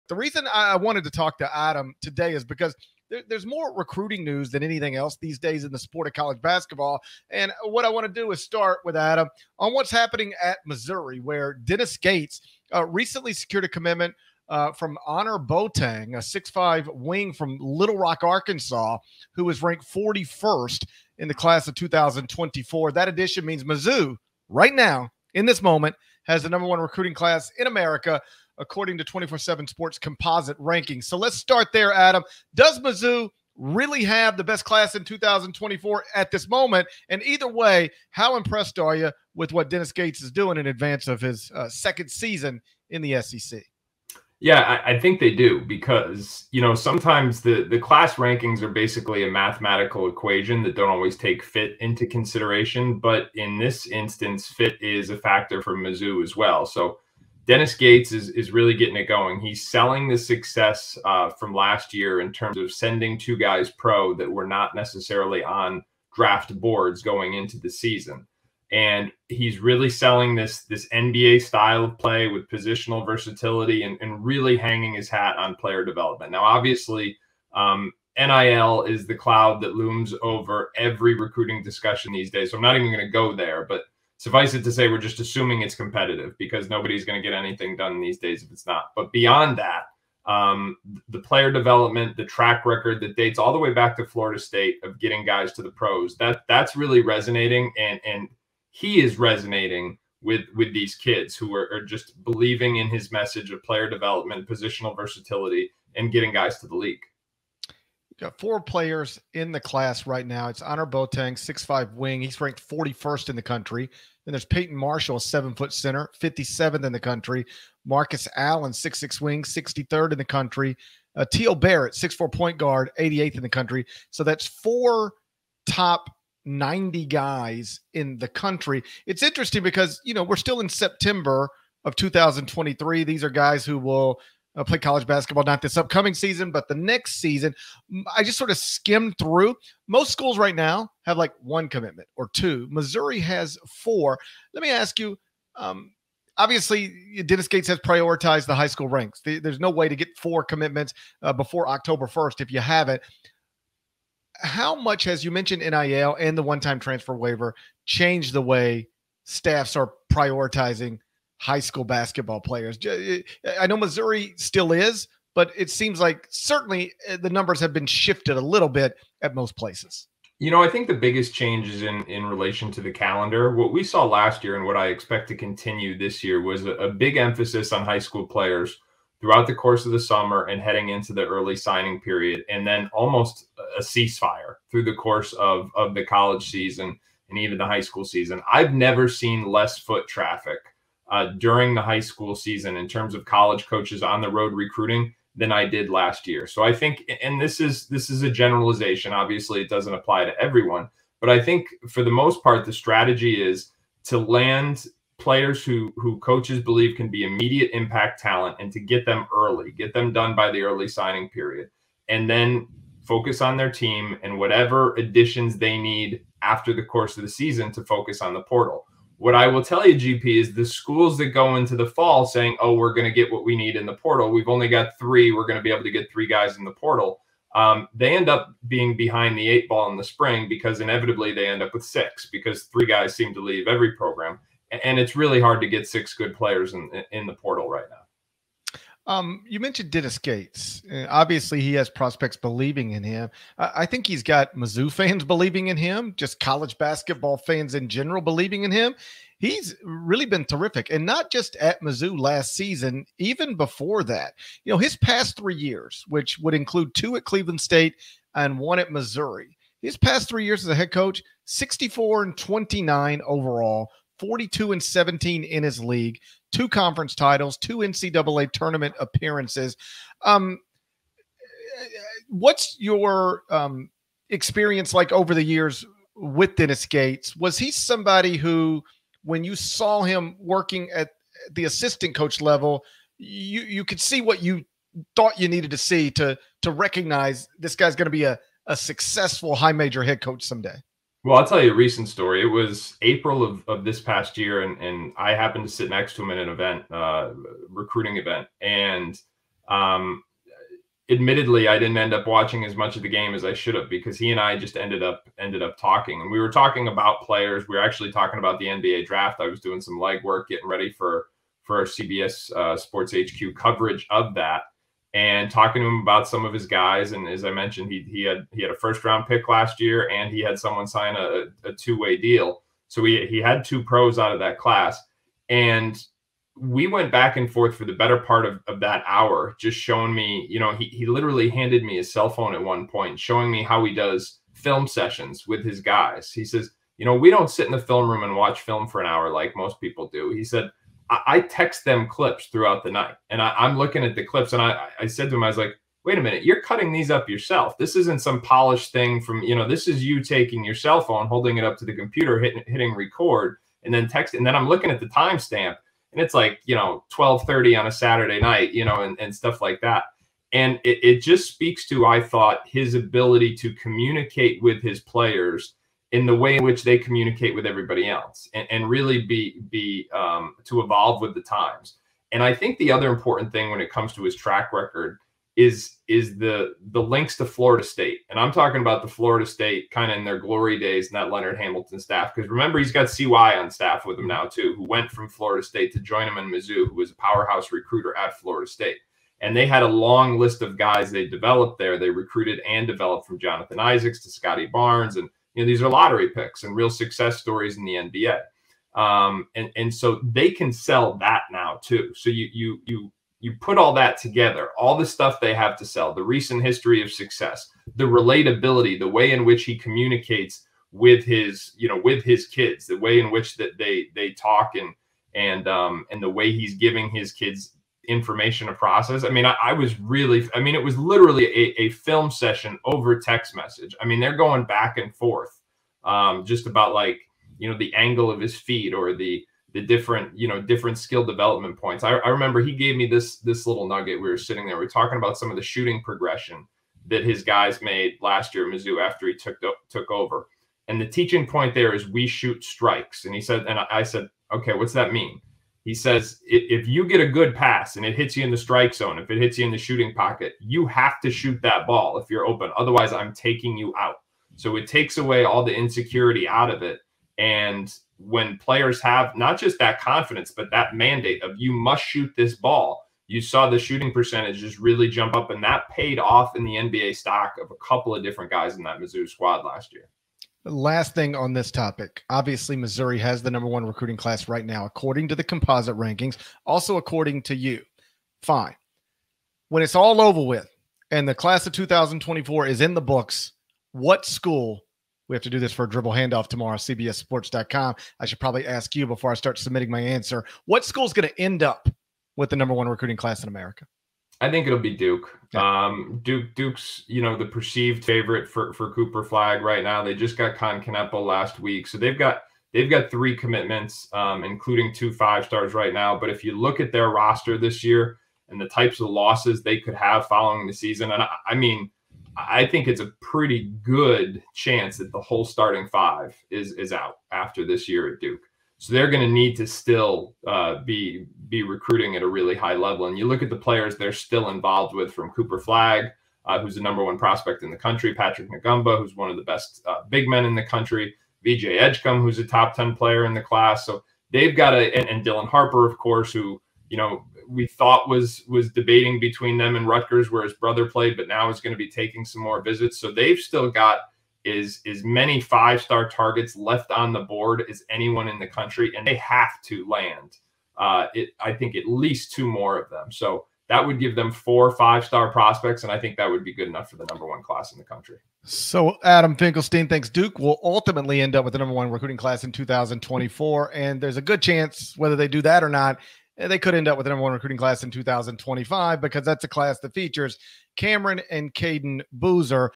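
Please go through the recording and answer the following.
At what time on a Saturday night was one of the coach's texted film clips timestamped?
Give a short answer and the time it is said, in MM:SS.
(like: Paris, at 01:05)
12:30, at 05:57.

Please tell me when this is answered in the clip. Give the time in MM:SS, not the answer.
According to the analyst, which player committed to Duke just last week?
08:20.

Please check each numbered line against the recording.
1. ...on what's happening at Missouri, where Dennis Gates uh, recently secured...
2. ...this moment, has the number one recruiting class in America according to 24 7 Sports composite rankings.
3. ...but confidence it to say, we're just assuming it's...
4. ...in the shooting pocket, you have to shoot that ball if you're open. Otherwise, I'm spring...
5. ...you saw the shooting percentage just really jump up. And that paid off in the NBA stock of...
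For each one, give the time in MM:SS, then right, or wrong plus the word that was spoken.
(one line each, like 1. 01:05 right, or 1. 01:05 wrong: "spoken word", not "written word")
1. 00:09 right
2. 00:25 right
3. 01:23 wrong: "suffice", not "confidence"
4. 07:29 wrong: "taking", not "spring"
5. 07:43 right.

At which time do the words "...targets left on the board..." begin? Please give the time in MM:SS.
09:06.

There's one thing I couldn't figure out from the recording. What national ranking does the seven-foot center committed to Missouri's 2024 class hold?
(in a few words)
57th.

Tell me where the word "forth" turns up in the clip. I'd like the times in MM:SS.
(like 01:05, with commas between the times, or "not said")
05:27, 07:05.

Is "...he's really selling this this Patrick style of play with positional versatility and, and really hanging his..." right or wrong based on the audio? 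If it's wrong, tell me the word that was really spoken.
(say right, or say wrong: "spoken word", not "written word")
wrong: "NBA", not "Patrick".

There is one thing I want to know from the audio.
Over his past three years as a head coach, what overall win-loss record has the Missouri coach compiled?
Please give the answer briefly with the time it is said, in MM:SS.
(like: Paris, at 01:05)
64 and 29, at 04:21.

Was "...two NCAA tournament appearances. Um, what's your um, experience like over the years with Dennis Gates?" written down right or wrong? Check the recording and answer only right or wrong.
right.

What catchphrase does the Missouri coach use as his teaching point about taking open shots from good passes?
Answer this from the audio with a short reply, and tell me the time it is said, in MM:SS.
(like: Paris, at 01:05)
we shoot strikes, at 07:22.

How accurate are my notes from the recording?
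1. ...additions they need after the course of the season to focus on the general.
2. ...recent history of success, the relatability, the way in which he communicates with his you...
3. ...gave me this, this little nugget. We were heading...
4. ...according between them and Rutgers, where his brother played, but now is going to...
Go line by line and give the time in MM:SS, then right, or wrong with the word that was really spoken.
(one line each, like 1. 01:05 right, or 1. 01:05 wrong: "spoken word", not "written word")
1. 03:34 wrong: "portal", not "general"
2. 06:46 right
3. 07:12 wrong: "sitting", not "heading"
4. 08:58 wrong: "debating", not "according".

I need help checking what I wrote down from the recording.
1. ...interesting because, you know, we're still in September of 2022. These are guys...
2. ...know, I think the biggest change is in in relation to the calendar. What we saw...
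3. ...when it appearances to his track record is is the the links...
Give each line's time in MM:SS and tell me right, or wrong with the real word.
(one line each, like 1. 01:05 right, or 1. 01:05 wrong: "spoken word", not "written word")
1. 02:09 wrong: "2023", not "2022"
2. 02:50 right
3. 06:13 wrong: "comes", not "appearances".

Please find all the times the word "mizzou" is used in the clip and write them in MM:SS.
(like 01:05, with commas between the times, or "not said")
00:23, 00:32, 00:55, 04:04, 04:11, 06:26, 07:18, 07:48.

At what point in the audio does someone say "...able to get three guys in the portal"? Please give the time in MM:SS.
03:45.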